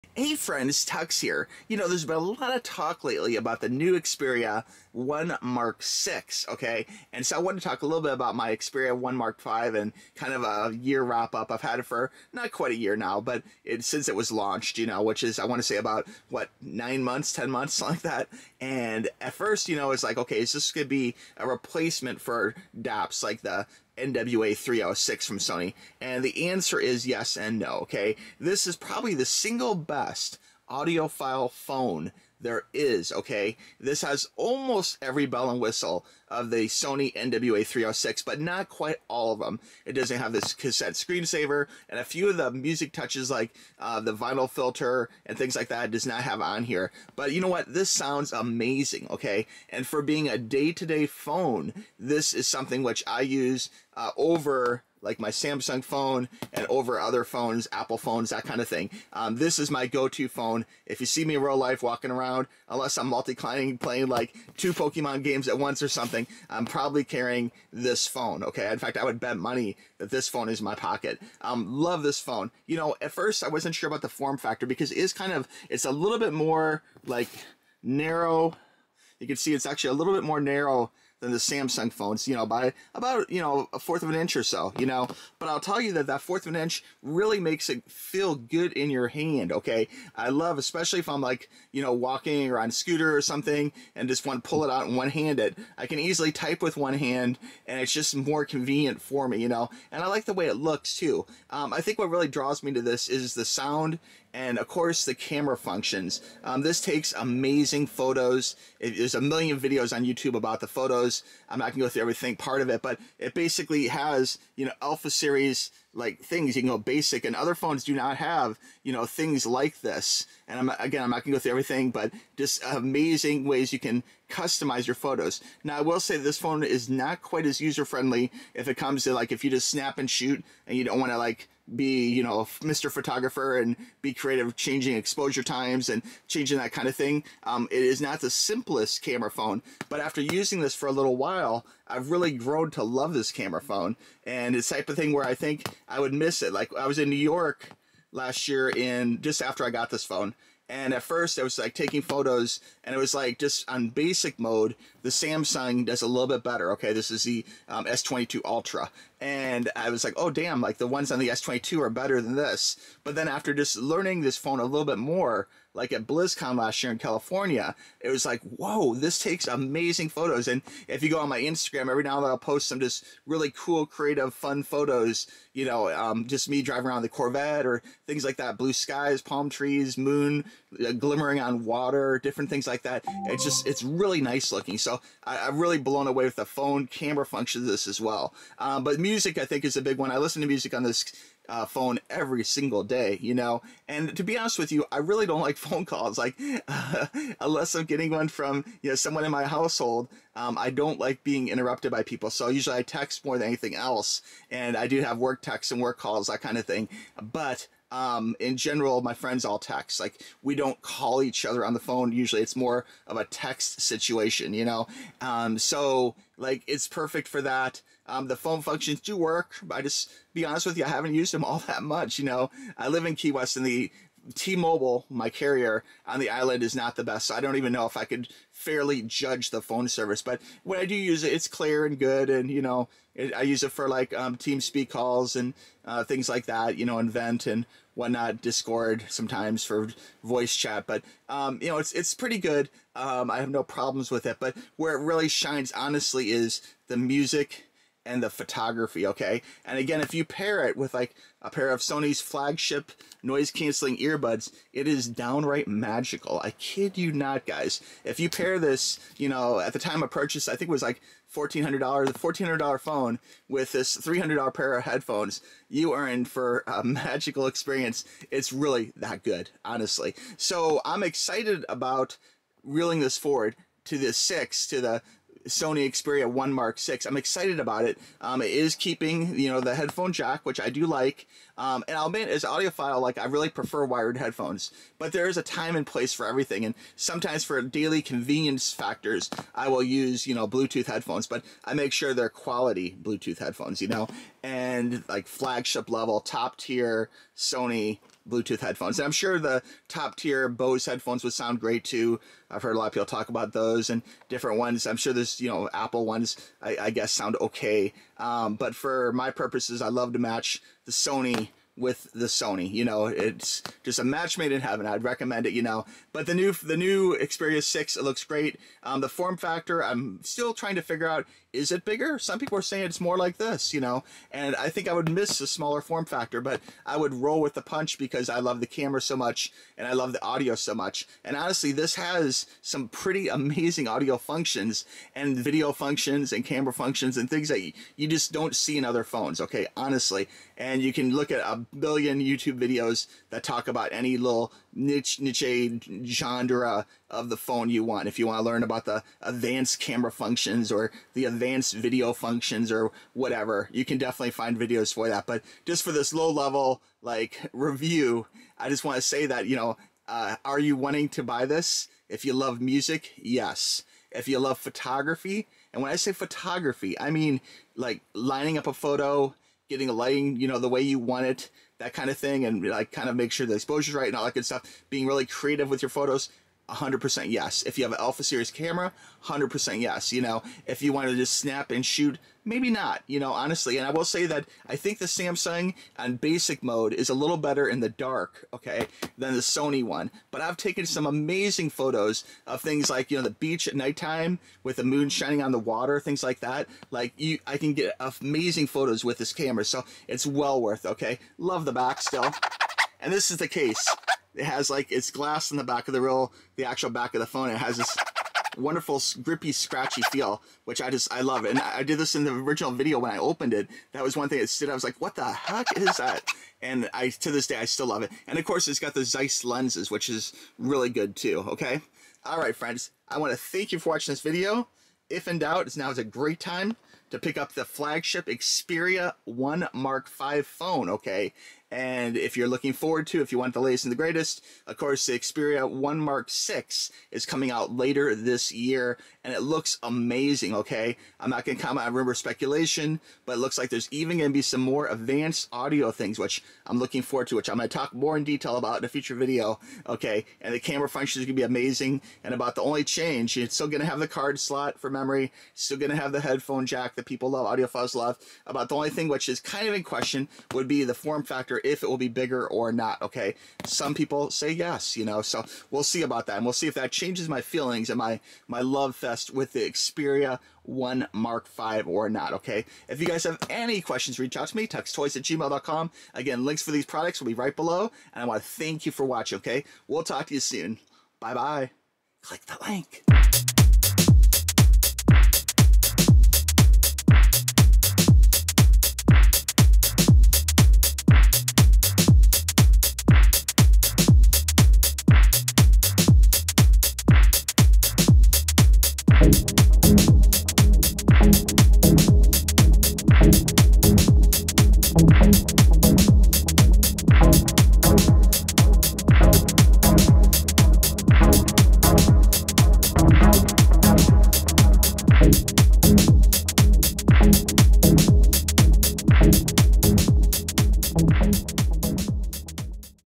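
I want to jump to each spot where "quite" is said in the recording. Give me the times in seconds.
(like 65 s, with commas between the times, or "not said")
12 s, 38 s, 127 s.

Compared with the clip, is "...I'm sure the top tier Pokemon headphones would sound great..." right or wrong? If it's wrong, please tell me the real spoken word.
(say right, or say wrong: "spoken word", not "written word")
wrong: "Bose", not "Pokemon".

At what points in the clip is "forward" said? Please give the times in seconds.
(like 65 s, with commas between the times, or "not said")
273 s, 432 s, 447 s.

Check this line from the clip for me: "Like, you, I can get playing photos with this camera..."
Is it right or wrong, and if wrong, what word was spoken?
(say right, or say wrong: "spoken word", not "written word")
wrong: "amazing", not "playing".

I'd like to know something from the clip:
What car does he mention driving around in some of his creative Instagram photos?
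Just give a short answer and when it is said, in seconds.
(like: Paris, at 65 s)
Corvette, at 177 s.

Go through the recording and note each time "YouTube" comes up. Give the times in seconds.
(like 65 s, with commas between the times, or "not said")
110 s, 342 s.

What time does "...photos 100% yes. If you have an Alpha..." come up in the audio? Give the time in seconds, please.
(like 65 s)
375 s.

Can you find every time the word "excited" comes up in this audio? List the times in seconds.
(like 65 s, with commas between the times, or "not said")
271 s, 277 s.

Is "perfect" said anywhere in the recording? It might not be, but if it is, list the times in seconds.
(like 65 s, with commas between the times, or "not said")
216 s.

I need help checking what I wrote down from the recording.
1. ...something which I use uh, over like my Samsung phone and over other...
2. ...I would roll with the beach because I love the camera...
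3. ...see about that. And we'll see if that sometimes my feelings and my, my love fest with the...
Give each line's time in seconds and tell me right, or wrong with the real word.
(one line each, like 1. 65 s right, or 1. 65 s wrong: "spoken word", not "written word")
1. 52 s right
2. 326 s wrong: "punch", not "beach"
3. 465 s wrong: "changes", not "sometimes".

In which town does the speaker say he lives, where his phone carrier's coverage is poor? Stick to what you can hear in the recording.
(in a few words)
Key West.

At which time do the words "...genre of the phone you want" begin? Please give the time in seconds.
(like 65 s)
346 s.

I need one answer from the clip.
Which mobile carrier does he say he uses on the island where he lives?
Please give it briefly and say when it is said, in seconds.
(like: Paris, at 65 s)
T-Mobile, at 224 s.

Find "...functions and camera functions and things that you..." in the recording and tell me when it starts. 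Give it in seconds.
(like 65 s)
335 s.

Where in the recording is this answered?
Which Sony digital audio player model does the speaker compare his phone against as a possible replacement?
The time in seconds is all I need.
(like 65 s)
23 s.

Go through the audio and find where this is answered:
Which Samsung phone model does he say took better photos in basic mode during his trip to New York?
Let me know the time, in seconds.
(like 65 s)
157 s.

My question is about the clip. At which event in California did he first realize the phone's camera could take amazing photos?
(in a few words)
BlizzCon.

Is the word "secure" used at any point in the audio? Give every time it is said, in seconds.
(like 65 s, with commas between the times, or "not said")
not said.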